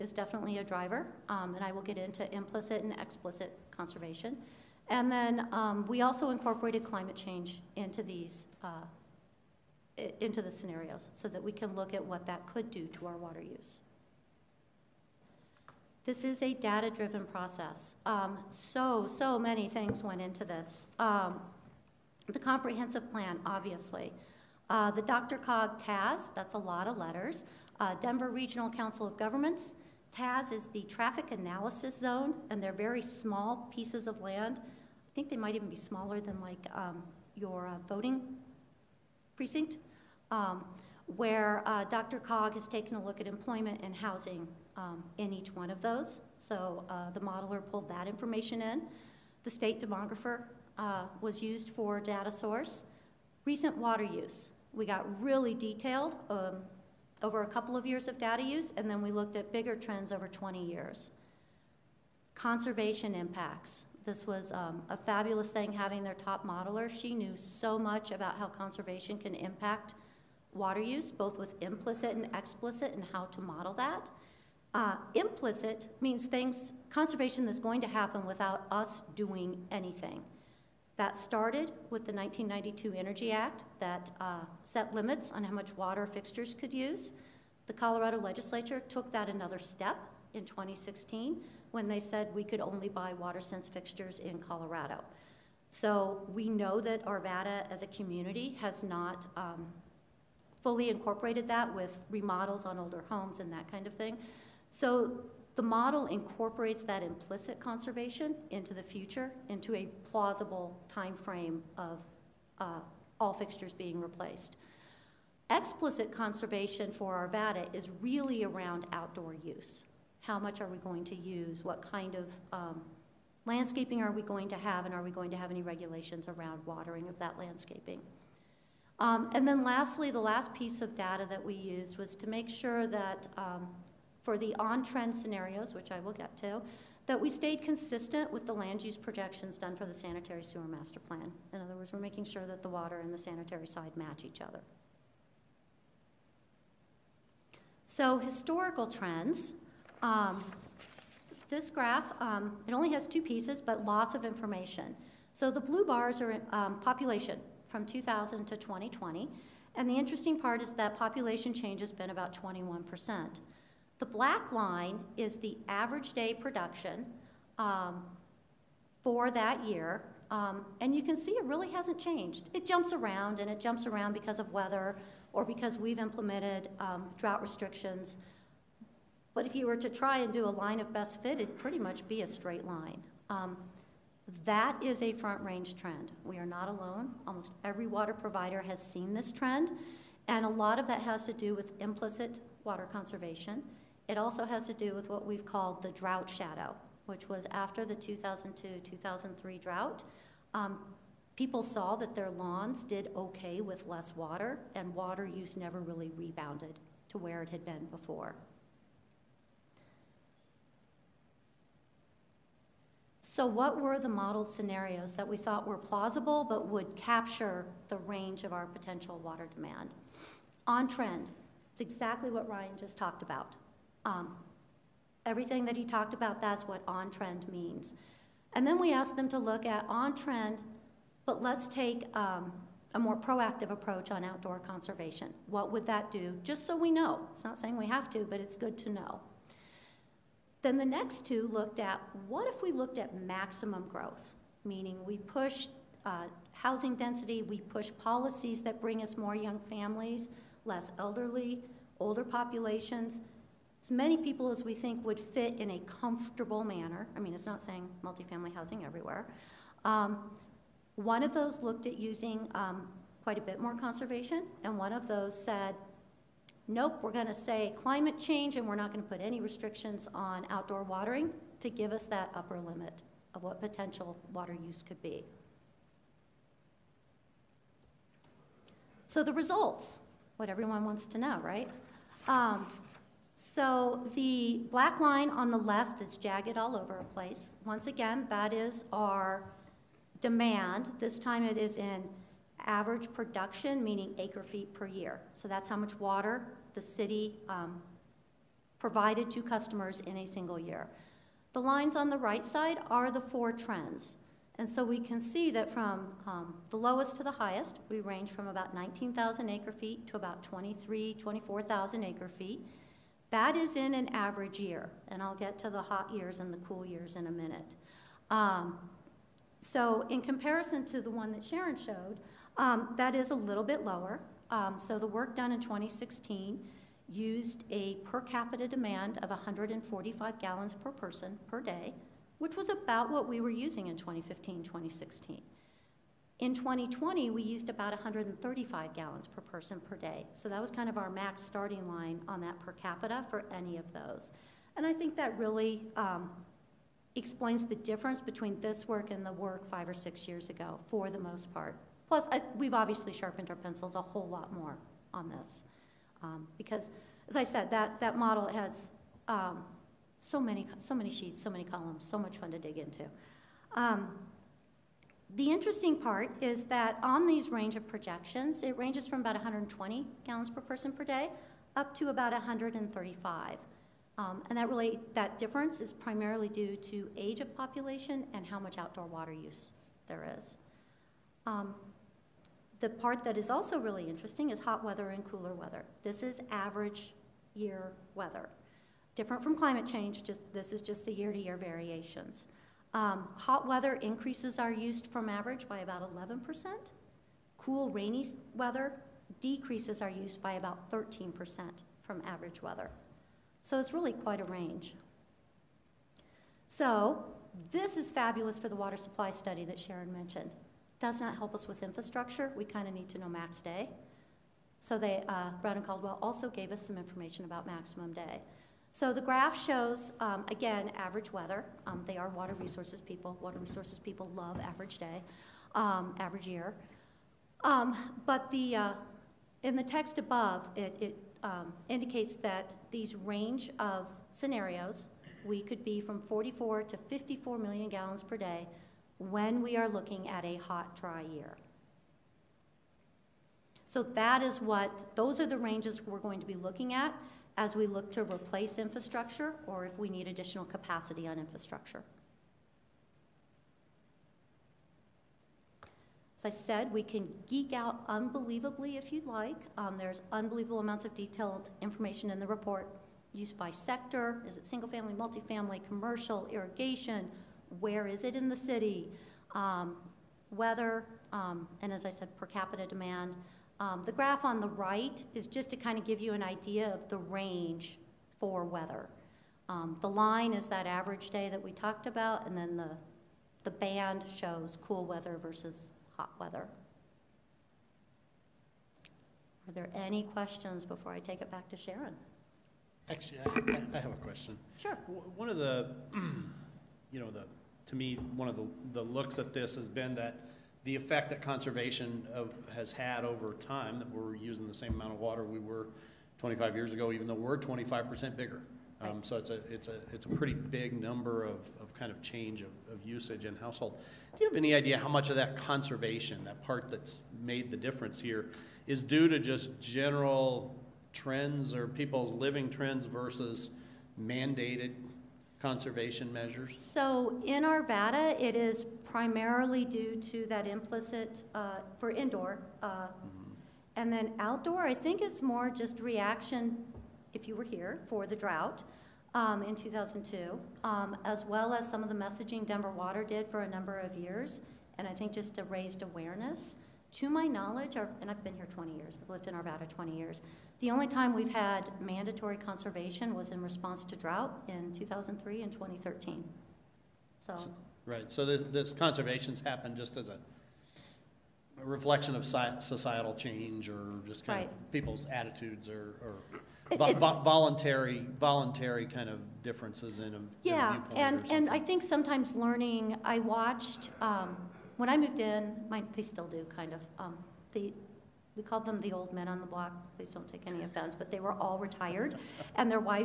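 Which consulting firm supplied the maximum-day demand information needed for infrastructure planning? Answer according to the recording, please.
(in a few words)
Brown and Caldwell.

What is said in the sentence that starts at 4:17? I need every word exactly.
I mean, it's not saying multifamily housing everywhere.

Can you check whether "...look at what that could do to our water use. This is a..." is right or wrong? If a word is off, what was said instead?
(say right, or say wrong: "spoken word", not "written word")
right.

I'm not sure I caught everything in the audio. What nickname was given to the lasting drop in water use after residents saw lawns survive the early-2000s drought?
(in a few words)
drought shadow.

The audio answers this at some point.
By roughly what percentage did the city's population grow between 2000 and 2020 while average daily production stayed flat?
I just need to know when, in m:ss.
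2:42.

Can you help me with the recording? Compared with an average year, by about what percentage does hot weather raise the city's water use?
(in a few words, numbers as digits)
11%.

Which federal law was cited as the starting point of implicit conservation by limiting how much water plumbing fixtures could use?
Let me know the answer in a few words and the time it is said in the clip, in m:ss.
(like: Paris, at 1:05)
1992 Energy Act, at 1:22.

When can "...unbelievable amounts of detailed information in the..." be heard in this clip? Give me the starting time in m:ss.
7:40.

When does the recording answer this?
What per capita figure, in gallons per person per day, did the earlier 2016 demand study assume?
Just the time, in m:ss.
5:29.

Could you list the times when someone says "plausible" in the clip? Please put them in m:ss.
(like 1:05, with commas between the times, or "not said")
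1:50, 3:35.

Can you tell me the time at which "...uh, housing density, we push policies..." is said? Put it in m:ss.
4:06.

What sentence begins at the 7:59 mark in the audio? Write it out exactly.
Um, the line is that average day that we talked about, and then the, the band shows cool weather versus hot weather.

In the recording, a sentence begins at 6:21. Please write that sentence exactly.
Um, the part that is also really interesting is hot weather and cooler weather.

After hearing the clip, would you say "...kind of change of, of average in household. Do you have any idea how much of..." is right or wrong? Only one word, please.
wrong.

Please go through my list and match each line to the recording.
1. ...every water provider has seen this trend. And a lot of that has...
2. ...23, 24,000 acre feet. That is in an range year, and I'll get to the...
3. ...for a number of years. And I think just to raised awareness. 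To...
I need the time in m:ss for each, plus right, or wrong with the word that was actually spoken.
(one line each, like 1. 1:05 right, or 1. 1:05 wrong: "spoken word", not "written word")
1. 3:07 right
2. 5:10 wrong: "average", not "range"
3. 9:03 right.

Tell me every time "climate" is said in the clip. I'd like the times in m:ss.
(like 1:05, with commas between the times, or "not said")
0:06, 4:27, 6:29.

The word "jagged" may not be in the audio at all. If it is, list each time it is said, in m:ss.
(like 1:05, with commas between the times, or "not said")
4:46.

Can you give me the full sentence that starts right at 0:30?
TAS is the traffic analysis zone, and they're very small pieces of land.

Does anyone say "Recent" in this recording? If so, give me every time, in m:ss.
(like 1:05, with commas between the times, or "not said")
0:53.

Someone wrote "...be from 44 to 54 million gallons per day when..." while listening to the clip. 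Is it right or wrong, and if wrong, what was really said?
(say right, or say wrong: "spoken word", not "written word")
right.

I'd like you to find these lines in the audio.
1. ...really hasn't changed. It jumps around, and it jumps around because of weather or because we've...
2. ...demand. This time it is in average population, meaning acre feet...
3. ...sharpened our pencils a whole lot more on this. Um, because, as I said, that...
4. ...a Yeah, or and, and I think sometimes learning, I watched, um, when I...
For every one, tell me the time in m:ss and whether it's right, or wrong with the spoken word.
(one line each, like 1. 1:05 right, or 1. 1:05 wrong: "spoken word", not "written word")
1. 2:51 right
2. 4:50 wrong: "production", not "population"
3. 5:53 right
4. 9:30 right.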